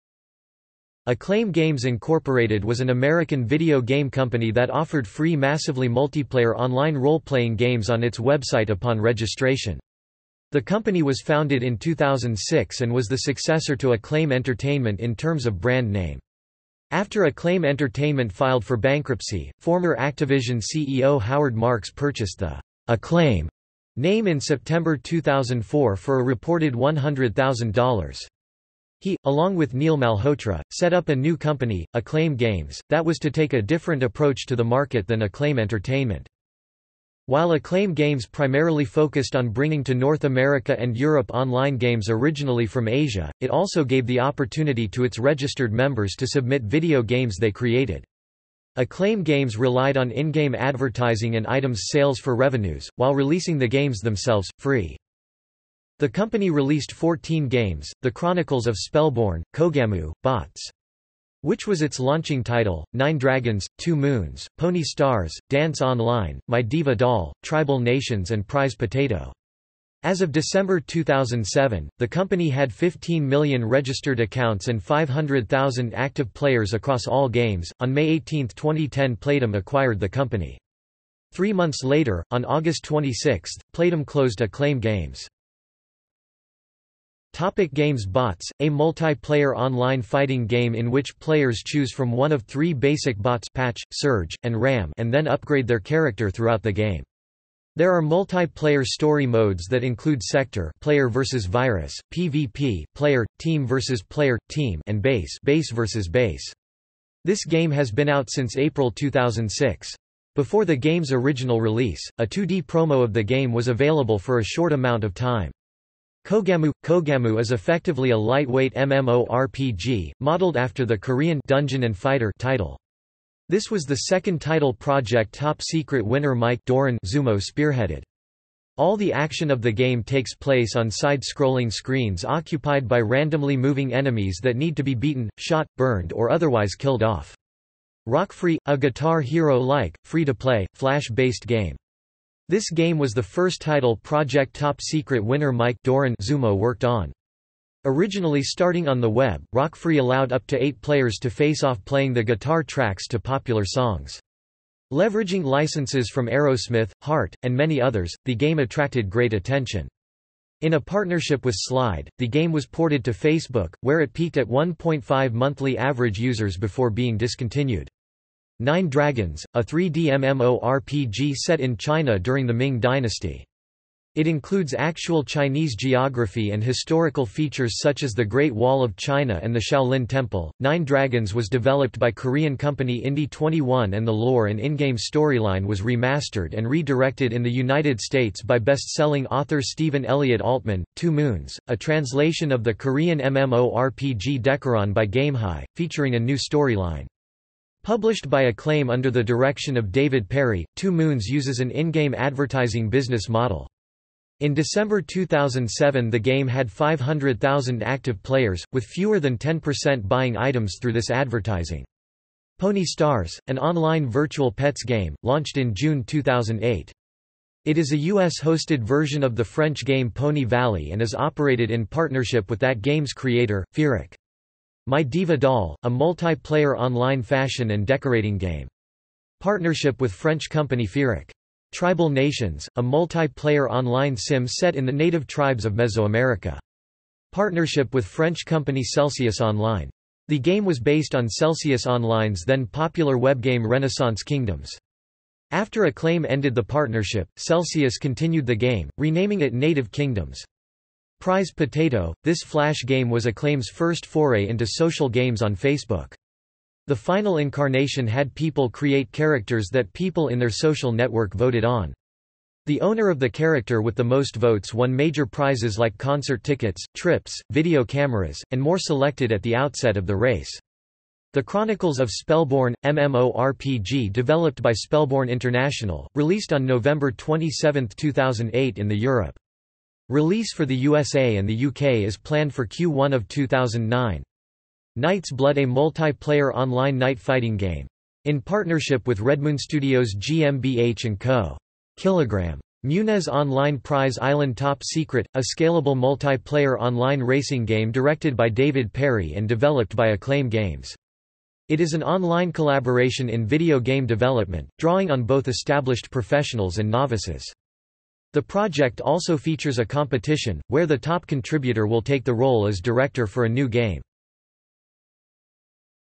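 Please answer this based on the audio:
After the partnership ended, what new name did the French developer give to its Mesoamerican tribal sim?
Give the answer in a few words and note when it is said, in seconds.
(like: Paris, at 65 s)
Native Kingdoms, at 249 s.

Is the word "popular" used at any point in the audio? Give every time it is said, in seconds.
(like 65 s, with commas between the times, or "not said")
153 s, 242 s.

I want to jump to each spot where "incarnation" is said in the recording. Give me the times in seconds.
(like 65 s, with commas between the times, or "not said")
257 s.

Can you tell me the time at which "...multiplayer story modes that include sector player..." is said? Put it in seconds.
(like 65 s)
98 s.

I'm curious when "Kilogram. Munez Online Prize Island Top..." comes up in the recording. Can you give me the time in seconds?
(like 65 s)
291 s.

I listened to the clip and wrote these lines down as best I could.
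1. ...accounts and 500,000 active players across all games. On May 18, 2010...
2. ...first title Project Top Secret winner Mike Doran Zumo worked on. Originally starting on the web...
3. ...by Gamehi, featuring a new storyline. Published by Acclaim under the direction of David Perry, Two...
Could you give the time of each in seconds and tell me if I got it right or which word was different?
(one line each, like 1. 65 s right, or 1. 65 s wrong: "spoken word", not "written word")
1. 74 s right
2. 143 s right
3. 194 s right.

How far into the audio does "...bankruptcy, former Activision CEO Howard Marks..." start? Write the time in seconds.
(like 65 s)
18 s.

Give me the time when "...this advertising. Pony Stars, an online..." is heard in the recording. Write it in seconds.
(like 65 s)
210 s.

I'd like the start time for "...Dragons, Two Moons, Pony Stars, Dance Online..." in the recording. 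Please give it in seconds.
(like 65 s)
63 s.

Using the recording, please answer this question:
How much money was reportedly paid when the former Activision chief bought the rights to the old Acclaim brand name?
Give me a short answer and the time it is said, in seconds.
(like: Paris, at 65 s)
$100,000, at 26 s.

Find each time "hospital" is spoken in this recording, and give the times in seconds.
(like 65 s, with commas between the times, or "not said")
not said.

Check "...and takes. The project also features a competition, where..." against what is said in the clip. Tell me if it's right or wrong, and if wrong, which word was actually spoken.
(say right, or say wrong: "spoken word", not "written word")
wrong: "novices", not "takes".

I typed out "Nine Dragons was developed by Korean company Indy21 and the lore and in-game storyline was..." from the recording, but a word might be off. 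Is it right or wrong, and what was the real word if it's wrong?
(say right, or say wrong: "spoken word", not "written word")
right.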